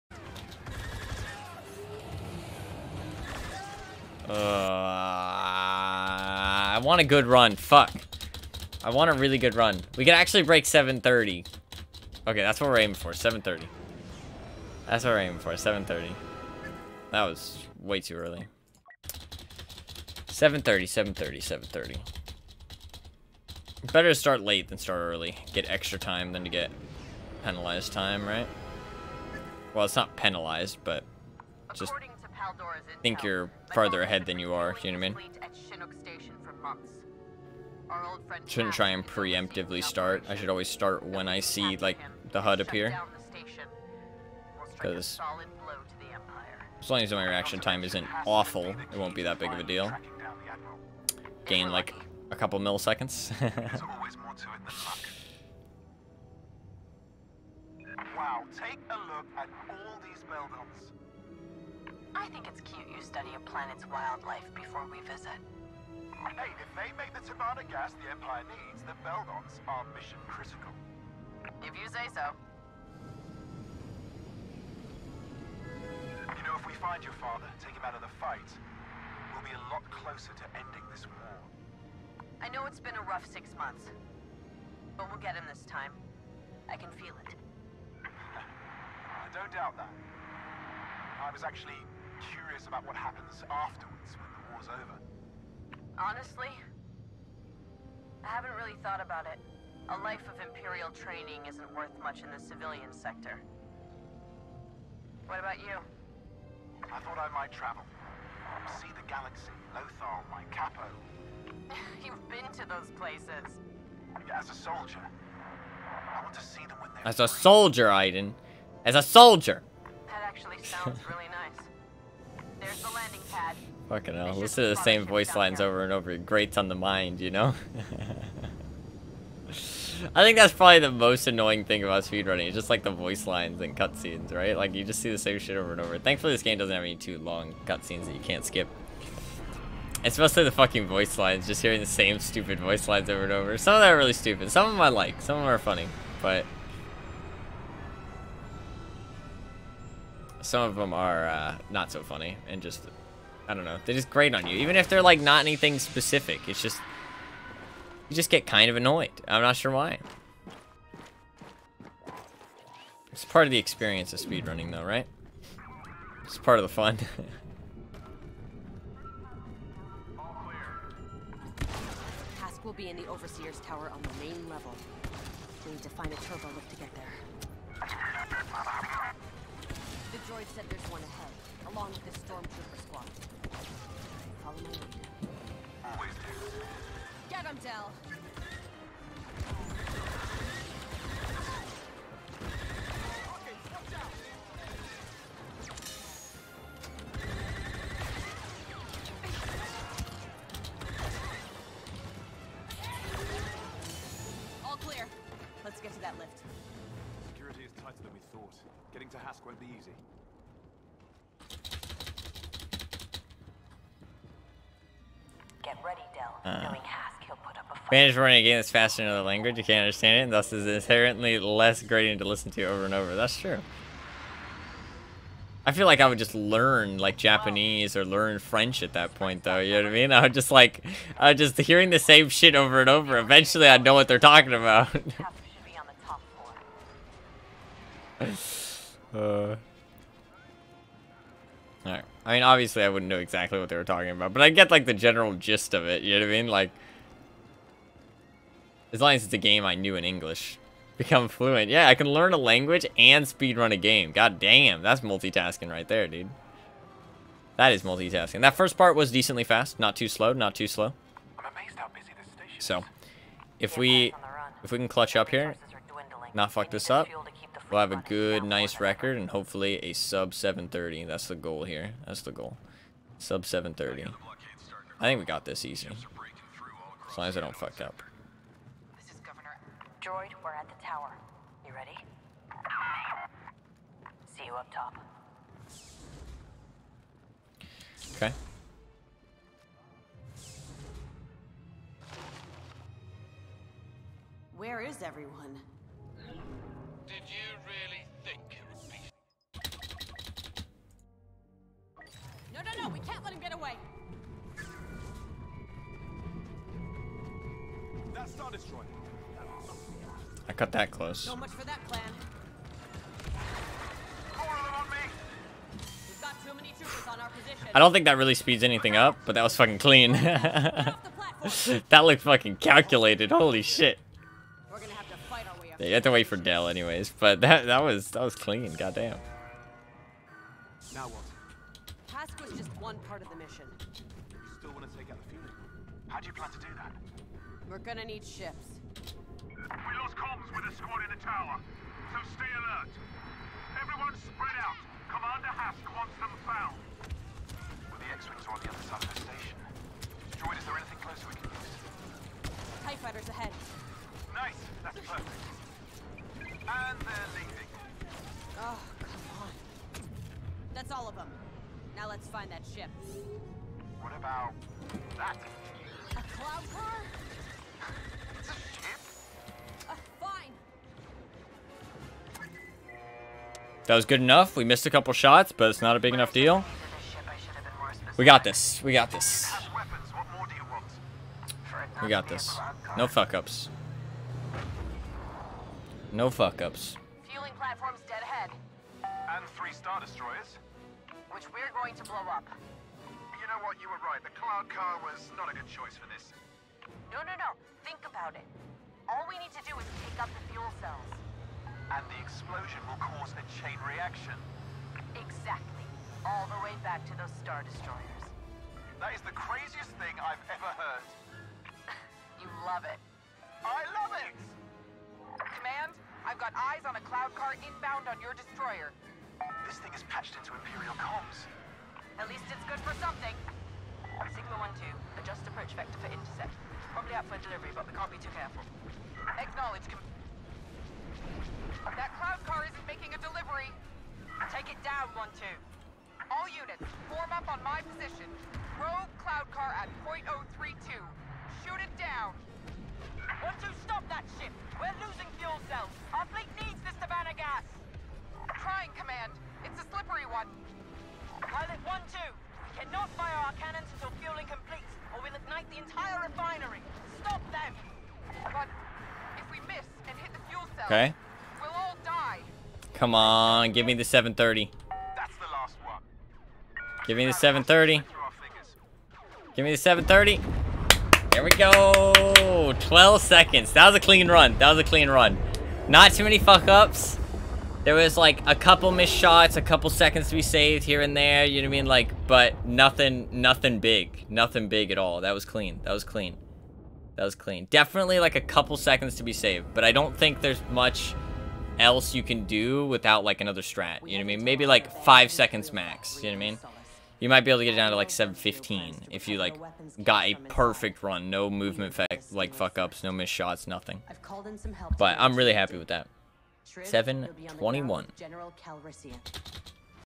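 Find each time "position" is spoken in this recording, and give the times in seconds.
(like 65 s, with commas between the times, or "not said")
437 s.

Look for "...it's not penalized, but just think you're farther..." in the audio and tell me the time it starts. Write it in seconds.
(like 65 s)
29 s.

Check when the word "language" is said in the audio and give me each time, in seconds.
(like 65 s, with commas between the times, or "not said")
219 s, 252 s.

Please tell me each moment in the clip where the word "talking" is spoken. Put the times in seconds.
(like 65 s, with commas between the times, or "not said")
234 s, 243 s.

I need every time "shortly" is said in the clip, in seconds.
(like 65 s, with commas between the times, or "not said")
not said.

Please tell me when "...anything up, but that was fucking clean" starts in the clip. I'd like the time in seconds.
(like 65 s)
318 s.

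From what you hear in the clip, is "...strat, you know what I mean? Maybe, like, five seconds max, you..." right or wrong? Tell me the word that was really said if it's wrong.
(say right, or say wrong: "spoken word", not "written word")
right.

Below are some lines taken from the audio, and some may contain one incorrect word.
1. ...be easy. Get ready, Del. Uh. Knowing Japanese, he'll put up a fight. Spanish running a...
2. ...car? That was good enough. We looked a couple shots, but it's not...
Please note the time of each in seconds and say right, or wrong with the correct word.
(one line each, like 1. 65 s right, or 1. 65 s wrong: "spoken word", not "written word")
1. 209 s wrong: "Hask", not "Japanese"
2. 366 s wrong: "missed", not "looked".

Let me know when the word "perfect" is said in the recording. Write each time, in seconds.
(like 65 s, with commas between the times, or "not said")
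354 s, 500 s.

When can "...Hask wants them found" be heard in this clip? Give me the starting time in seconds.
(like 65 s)
345 s.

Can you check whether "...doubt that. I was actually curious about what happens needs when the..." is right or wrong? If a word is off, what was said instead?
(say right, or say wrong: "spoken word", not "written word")
wrong: "afterwards", not "needs".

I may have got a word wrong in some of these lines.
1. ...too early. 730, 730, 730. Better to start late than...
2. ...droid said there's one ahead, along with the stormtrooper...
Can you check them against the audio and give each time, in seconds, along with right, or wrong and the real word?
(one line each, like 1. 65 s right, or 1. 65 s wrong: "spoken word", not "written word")
1. 17 s right
2. 180 s right.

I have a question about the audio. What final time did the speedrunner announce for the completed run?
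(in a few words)
721.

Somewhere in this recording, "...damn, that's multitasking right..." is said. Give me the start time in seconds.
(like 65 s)
254 s.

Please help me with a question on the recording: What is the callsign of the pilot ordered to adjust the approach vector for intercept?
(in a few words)
Sigma 1-2.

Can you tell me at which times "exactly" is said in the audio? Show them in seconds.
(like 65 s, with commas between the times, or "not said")
243 s, 405 s.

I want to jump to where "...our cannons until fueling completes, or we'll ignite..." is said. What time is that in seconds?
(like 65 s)
453 s.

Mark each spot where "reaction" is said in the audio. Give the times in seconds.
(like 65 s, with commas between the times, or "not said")
47 s, 403 s.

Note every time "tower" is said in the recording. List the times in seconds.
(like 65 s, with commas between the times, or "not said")
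173 s, 280 s, 341 s.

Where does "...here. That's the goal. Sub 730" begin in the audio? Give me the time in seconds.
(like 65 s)
271 s.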